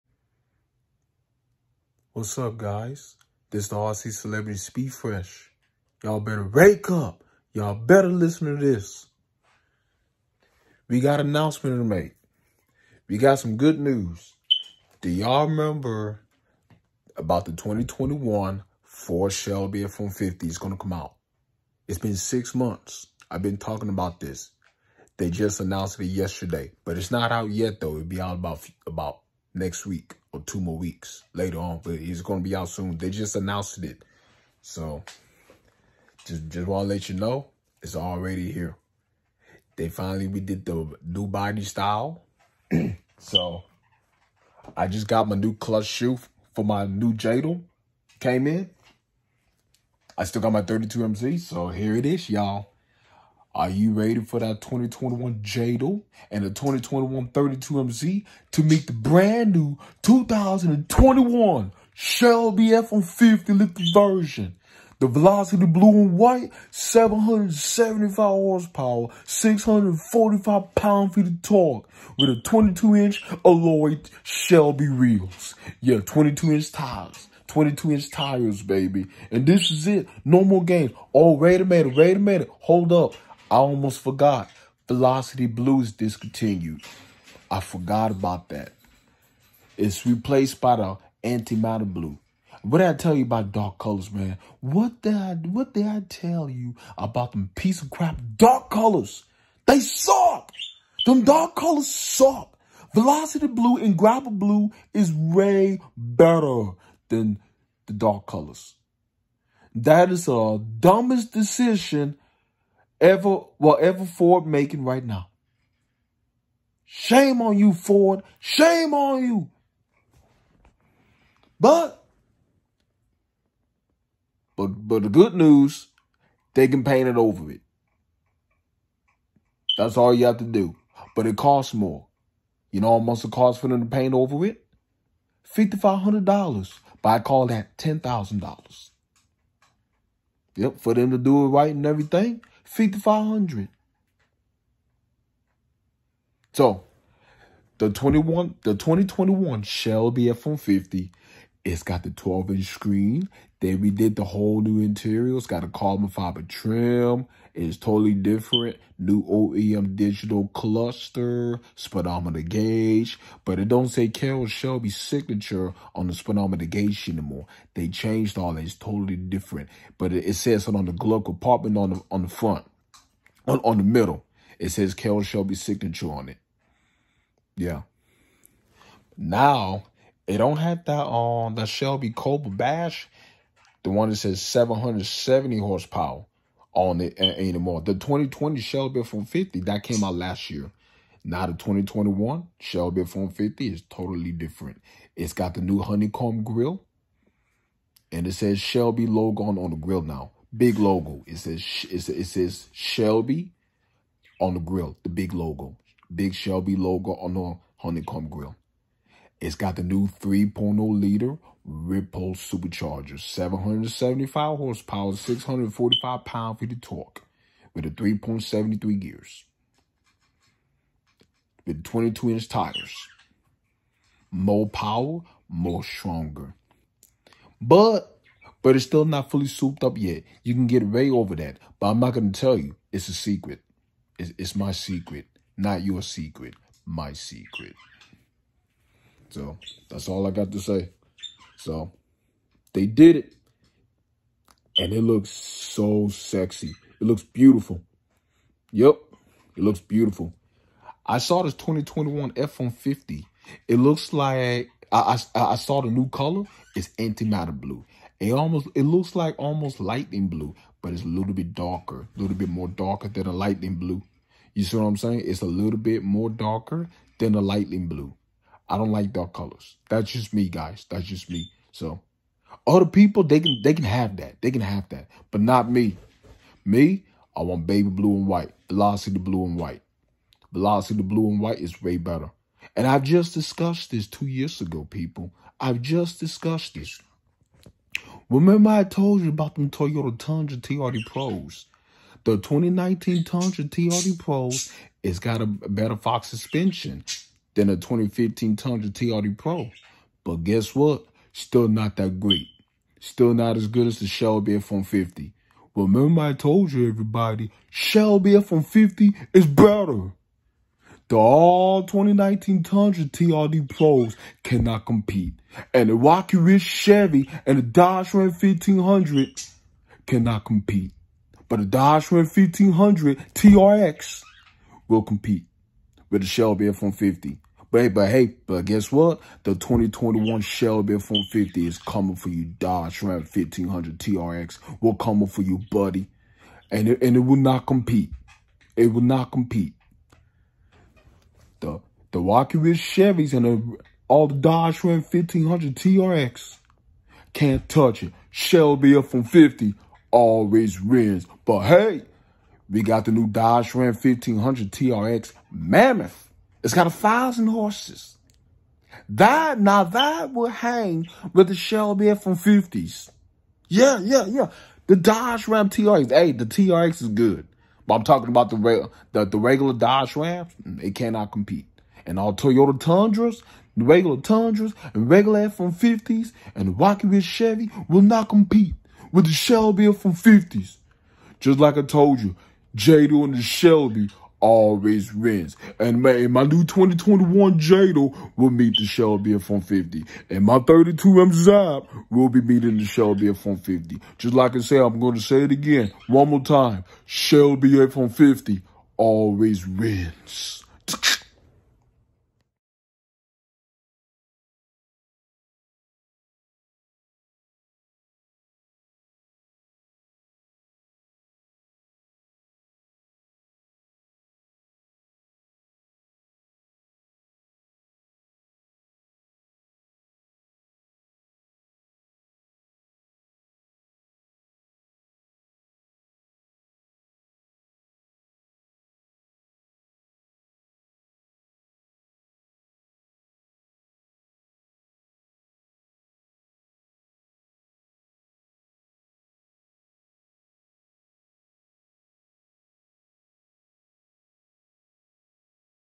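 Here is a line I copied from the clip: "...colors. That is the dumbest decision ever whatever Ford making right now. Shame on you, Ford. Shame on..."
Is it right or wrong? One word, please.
right.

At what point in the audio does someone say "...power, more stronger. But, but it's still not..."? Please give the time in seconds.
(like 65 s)
224 s.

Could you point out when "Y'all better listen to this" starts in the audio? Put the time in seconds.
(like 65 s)
7 s.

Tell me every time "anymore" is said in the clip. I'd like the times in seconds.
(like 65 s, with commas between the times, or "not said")
167 s, 187 s.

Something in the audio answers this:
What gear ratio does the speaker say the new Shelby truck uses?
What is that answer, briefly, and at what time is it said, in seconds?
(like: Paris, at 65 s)
3.73, at 217 s.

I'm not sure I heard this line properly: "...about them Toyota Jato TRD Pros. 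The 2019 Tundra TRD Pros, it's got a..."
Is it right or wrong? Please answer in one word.
wrong.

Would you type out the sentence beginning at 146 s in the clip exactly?
So the 21 the 2021 Shelby F150 it's got the 12-inch screen.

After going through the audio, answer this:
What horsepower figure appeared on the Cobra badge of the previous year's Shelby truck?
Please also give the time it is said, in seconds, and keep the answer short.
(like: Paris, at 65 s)
770, at 184 s.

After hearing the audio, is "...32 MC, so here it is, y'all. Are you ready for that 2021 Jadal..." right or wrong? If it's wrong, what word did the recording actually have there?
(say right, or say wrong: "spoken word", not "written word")
right.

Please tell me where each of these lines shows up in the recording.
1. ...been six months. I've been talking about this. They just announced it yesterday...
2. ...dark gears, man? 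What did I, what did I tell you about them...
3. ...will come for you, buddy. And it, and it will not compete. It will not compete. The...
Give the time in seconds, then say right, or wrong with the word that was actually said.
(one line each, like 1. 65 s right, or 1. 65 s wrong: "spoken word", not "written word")
1. 21 s right
2. 93 s wrong: "colors", not "gears"
3. 334 s right.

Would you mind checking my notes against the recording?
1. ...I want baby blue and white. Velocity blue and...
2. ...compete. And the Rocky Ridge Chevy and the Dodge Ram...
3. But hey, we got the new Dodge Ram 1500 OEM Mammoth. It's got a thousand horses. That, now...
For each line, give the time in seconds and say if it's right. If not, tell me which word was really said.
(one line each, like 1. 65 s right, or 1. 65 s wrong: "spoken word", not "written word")
1. 277 s right
2. 314 s right
3. 351 s wrong: "TRX", not "OEM".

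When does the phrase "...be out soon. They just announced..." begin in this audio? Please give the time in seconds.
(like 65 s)
32 s.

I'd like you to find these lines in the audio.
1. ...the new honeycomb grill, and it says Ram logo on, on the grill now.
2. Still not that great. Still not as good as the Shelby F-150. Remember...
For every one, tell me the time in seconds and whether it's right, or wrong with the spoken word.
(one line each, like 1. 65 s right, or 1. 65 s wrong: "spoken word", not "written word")
1. 195 s wrong: "Shelby", not "Ram"
2. 301 s right.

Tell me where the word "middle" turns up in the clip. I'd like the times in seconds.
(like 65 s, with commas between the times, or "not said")
173 s.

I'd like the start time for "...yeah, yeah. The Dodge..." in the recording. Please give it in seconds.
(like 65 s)
364 s.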